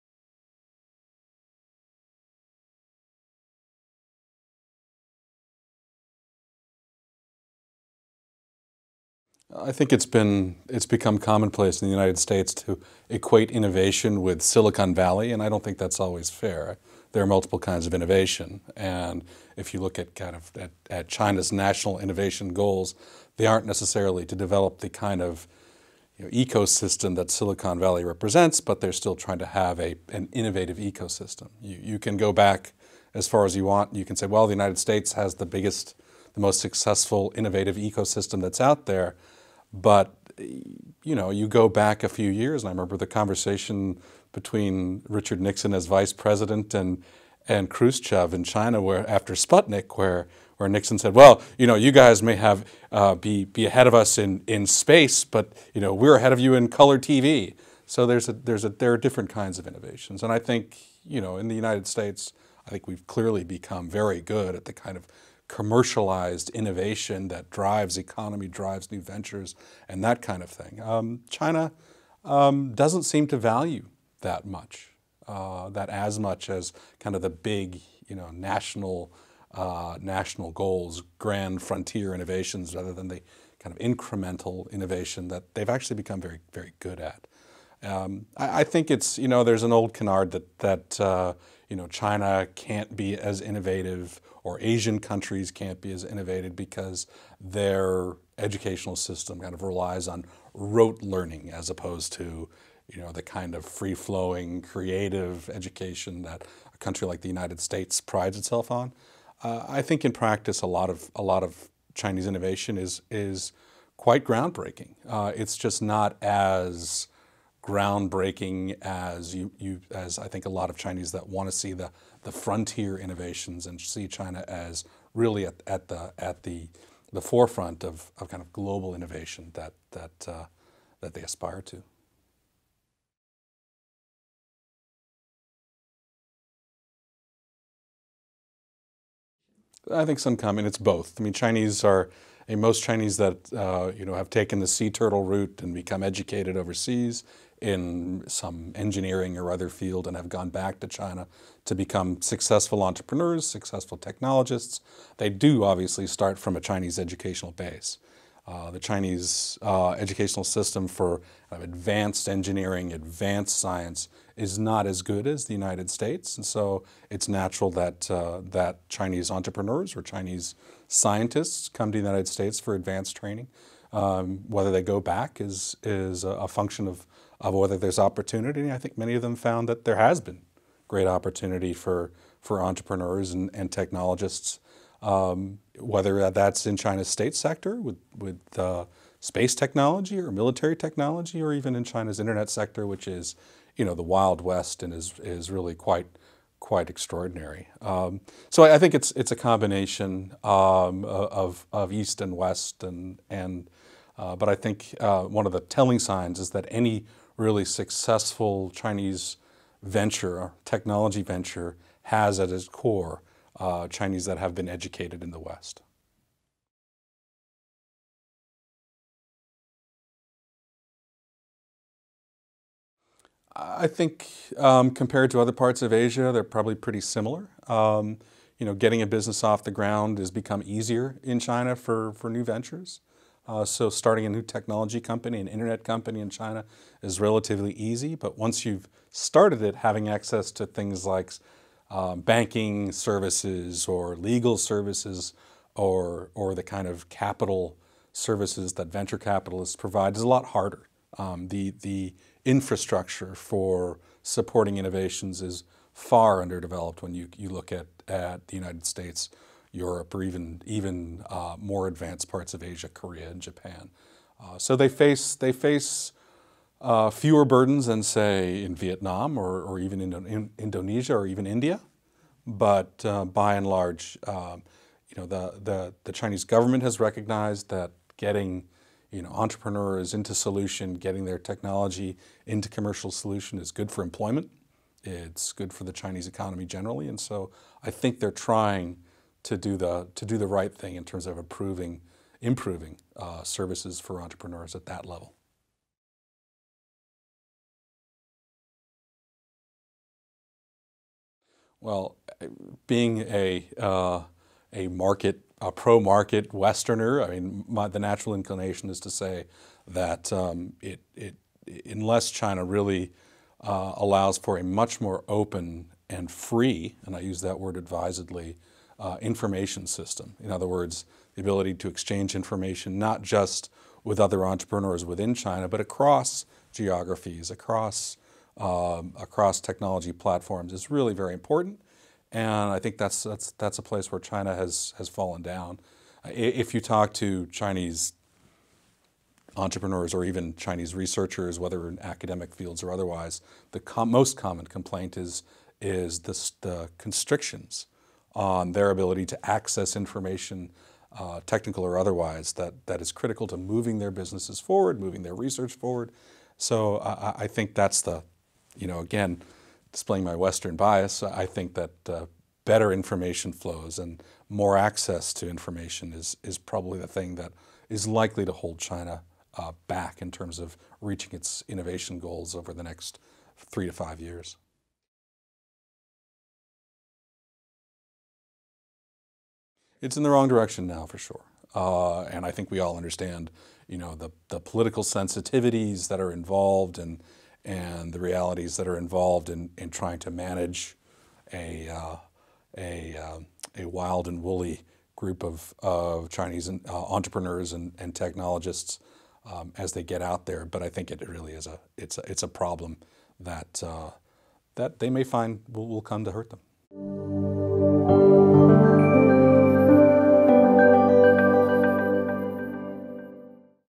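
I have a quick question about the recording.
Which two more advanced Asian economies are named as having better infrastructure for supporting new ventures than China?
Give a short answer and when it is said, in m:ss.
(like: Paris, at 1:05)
Korea and Japan, at 4:22.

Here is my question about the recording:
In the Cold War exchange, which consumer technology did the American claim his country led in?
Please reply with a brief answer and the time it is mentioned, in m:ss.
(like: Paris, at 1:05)
color TV, at 0:56.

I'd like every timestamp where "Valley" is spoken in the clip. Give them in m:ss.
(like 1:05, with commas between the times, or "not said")
0:14, 0:27.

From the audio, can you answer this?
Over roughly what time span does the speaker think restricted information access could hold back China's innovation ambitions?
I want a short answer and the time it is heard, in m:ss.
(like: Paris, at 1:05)
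3 to 5 years, at 6:13.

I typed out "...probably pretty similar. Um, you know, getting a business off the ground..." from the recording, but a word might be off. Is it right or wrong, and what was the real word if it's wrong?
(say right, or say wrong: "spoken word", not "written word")
right.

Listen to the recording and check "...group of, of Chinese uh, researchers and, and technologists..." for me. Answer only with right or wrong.
wrong.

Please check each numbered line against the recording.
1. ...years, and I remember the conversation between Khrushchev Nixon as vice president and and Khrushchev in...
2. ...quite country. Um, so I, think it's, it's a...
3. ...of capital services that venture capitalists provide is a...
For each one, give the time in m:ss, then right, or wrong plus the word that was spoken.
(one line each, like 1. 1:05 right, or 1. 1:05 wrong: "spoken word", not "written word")
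1. 0:42 wrong: "Richard", not "Khrushchev"
2. 3:16 wrong: "extraordinary", not "country"
3. 4:06 right.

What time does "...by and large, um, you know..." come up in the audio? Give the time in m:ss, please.
4:33.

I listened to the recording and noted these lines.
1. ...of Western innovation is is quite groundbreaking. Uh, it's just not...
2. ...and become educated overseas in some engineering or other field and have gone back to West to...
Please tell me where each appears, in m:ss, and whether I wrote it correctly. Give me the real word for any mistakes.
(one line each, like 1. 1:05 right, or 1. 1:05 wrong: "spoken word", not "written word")
1. 1:51 wrong: "Chinese", not "Western"
2. 2:25 wrong: "China", not "West".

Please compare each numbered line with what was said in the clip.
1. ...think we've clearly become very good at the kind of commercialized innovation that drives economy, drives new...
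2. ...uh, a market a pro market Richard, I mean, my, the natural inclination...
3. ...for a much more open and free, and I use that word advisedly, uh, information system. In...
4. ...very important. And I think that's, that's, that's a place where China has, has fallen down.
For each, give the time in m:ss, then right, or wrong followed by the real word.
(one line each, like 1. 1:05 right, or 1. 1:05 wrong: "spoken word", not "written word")
1. 1:02 right
2. 5:03 wrong: "Westerner", not "Richard"
3. 5:14 right
4. 5:31 right.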